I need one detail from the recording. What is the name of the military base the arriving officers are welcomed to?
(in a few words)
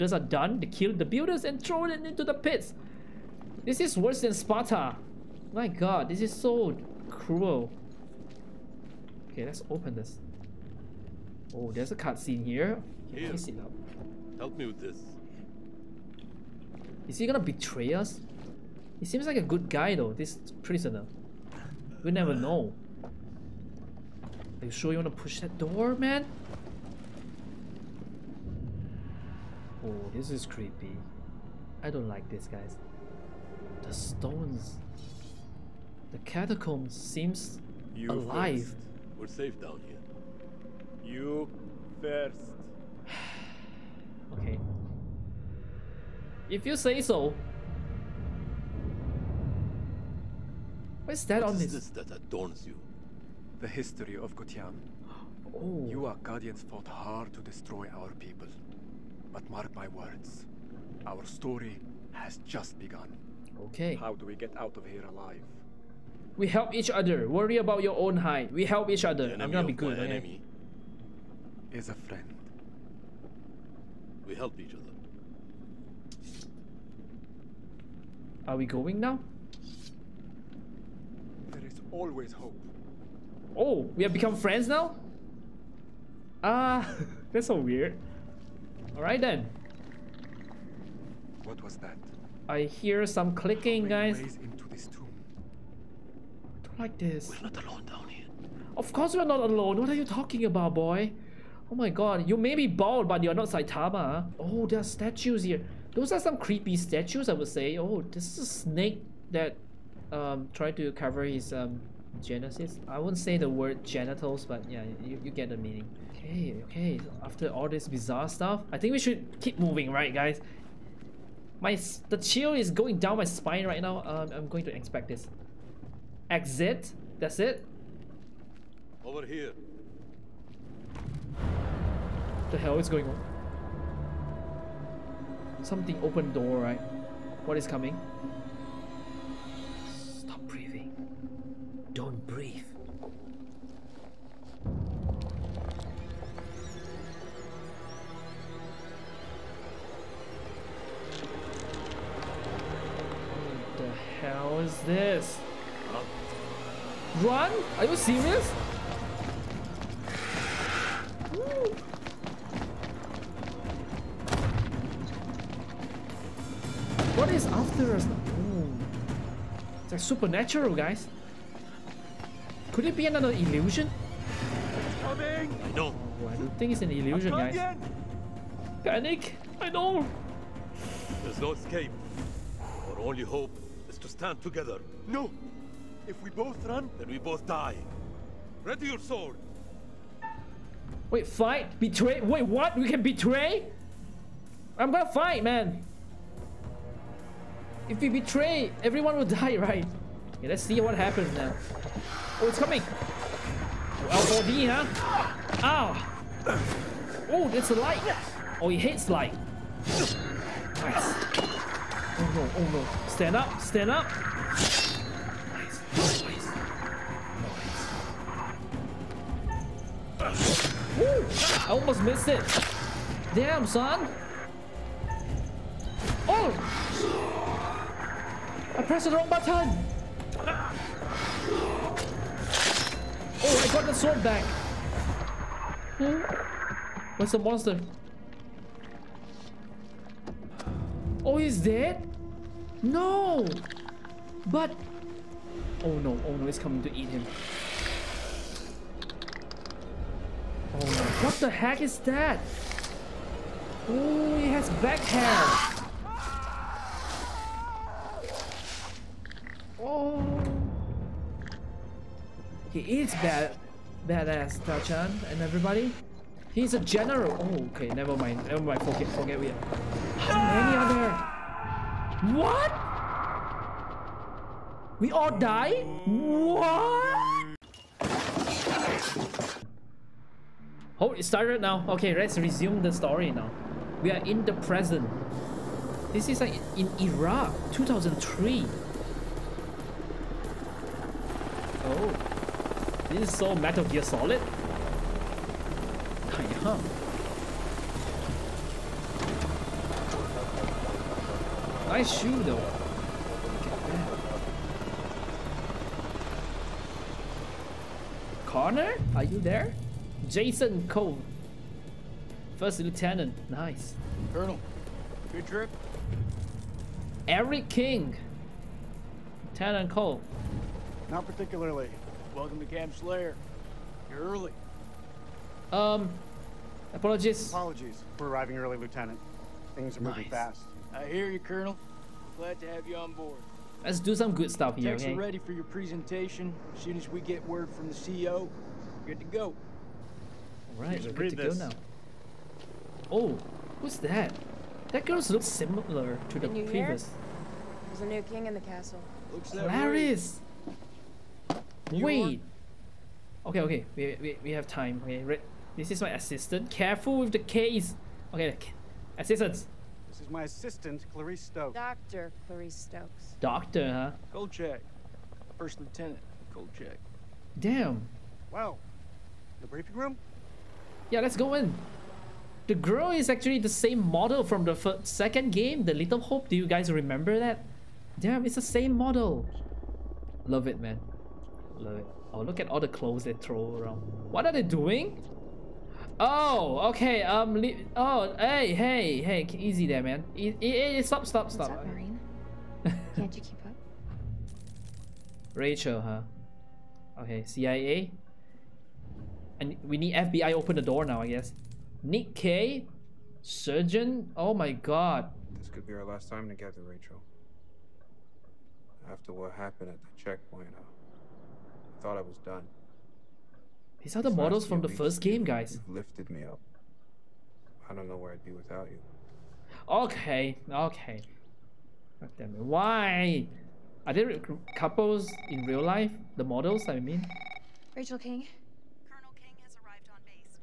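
Camp Slayer.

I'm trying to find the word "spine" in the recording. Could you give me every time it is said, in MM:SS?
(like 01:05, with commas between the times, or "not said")
02:03.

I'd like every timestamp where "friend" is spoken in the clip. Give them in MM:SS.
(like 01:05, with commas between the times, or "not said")
01:11, 01:24.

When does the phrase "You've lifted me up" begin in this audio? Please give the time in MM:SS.
06:55.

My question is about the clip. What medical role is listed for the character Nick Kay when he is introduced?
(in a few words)
Surgeon.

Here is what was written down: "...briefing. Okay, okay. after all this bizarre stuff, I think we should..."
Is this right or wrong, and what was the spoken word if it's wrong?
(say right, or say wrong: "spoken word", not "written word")
wrong: "meaning", not "briefing".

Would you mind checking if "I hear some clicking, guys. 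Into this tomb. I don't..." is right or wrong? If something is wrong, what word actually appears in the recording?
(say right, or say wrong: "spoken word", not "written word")
right.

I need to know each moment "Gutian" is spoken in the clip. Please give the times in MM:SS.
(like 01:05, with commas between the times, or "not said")
00:54.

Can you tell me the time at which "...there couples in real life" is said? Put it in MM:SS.
07:04.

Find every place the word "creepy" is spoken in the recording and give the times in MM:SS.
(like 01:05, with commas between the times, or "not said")
00:30, 01:46.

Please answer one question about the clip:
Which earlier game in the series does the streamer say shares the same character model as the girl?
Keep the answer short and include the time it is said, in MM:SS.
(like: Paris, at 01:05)
Little Hope, at 06:15.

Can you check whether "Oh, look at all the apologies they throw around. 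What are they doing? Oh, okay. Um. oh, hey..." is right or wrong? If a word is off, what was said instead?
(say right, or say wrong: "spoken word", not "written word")
wrong: "clothes", not "apologies".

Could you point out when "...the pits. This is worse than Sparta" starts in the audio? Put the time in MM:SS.
00:02.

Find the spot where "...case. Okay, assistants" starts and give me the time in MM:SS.
05:57.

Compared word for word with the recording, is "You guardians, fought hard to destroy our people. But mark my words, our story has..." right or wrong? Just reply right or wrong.
right.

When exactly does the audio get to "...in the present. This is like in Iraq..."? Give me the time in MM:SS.
04:44.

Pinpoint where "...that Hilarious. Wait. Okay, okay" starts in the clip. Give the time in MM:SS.
05:49.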